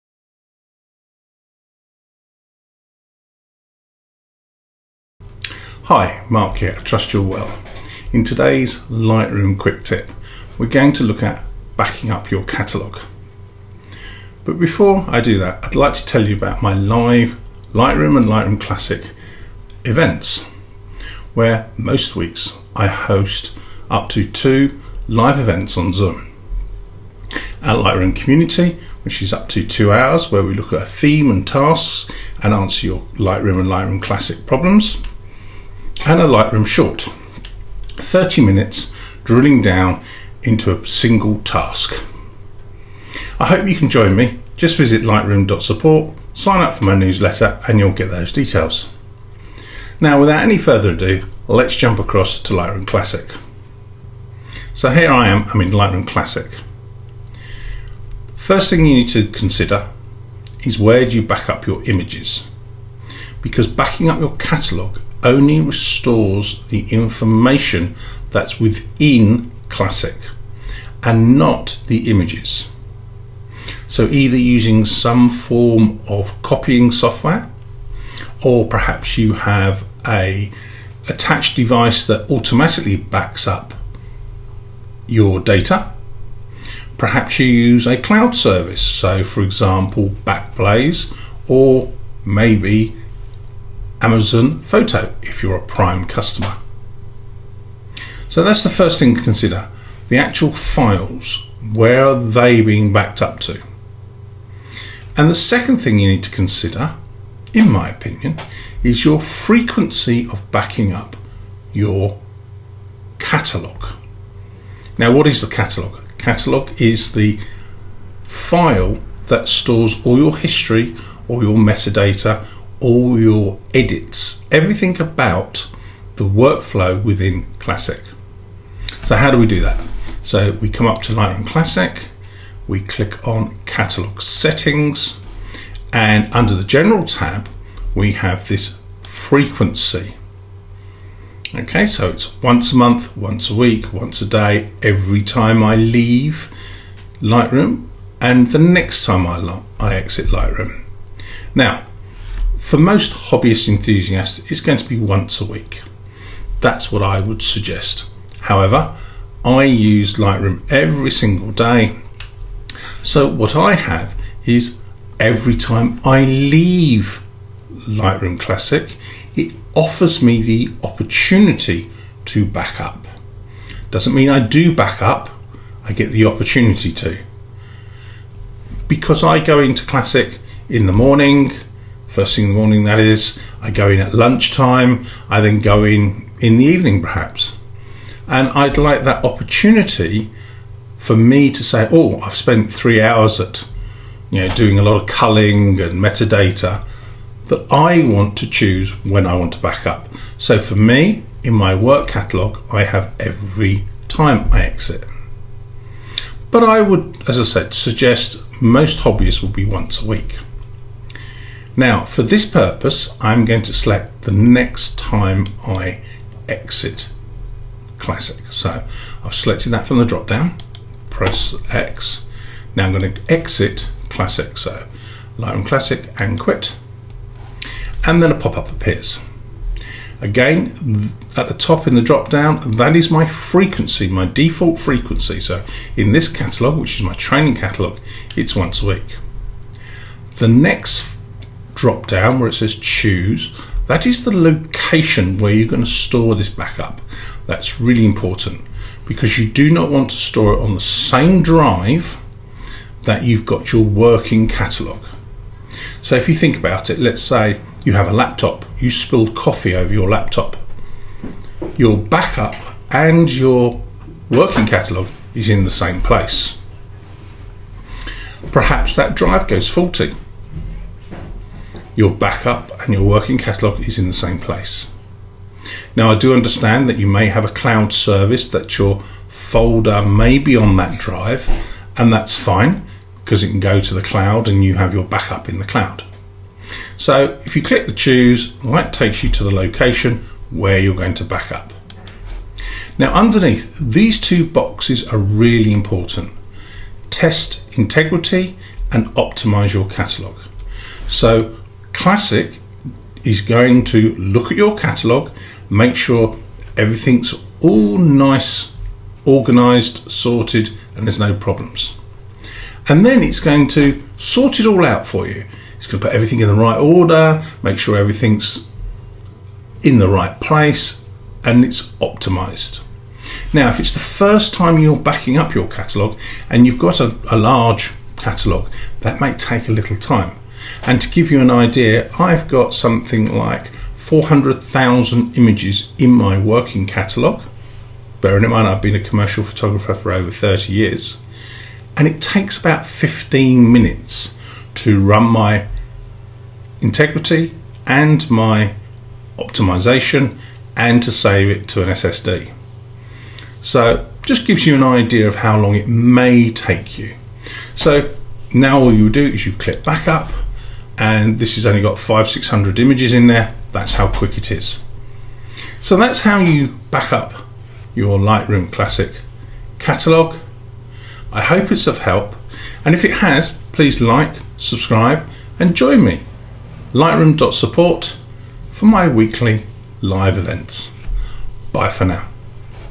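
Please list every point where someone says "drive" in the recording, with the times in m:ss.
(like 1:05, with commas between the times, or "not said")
4:11, 4:29, 4:40.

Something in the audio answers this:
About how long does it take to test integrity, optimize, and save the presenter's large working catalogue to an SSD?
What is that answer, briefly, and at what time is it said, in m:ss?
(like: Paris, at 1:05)
15 minutes, at 5:42.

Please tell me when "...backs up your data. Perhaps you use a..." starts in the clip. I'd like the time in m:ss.
1:22.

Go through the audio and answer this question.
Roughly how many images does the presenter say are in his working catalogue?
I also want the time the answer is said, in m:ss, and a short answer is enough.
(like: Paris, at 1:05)
400,000, at 5:33.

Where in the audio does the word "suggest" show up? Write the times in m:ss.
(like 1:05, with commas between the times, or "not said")
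2:37, 3:27.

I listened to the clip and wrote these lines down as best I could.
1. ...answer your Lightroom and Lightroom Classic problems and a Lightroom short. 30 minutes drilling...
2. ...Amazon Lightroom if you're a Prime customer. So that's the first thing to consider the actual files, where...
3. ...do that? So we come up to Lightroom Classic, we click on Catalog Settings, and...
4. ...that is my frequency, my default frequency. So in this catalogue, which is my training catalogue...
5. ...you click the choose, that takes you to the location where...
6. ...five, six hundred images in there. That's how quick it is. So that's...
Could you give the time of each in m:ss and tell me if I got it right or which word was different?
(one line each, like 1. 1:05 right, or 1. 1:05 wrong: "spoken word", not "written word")
1. 0:32 right
2. 1:34 wrong: "Photo", not "Lightroom"
3. 2:09 right
4. 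3:52 right
5. 4:47 right
6. 6:01 right.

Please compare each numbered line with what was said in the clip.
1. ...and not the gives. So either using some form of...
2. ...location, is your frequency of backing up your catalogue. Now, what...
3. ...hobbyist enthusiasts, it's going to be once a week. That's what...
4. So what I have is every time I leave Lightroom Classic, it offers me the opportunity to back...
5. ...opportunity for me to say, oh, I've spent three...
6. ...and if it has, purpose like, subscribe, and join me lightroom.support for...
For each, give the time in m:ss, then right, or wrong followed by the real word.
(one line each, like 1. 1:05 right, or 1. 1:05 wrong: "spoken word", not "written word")
1. 1:11 wrong: "images", not "gives"
2. 1:47 wrong: "opinion", not "location"
3. 2:33 right
4. 2:43 right
5. 3:09 right
6. 6:12 wrong: "please", not "purpose".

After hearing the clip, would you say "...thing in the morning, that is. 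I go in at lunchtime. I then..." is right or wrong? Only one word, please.
right.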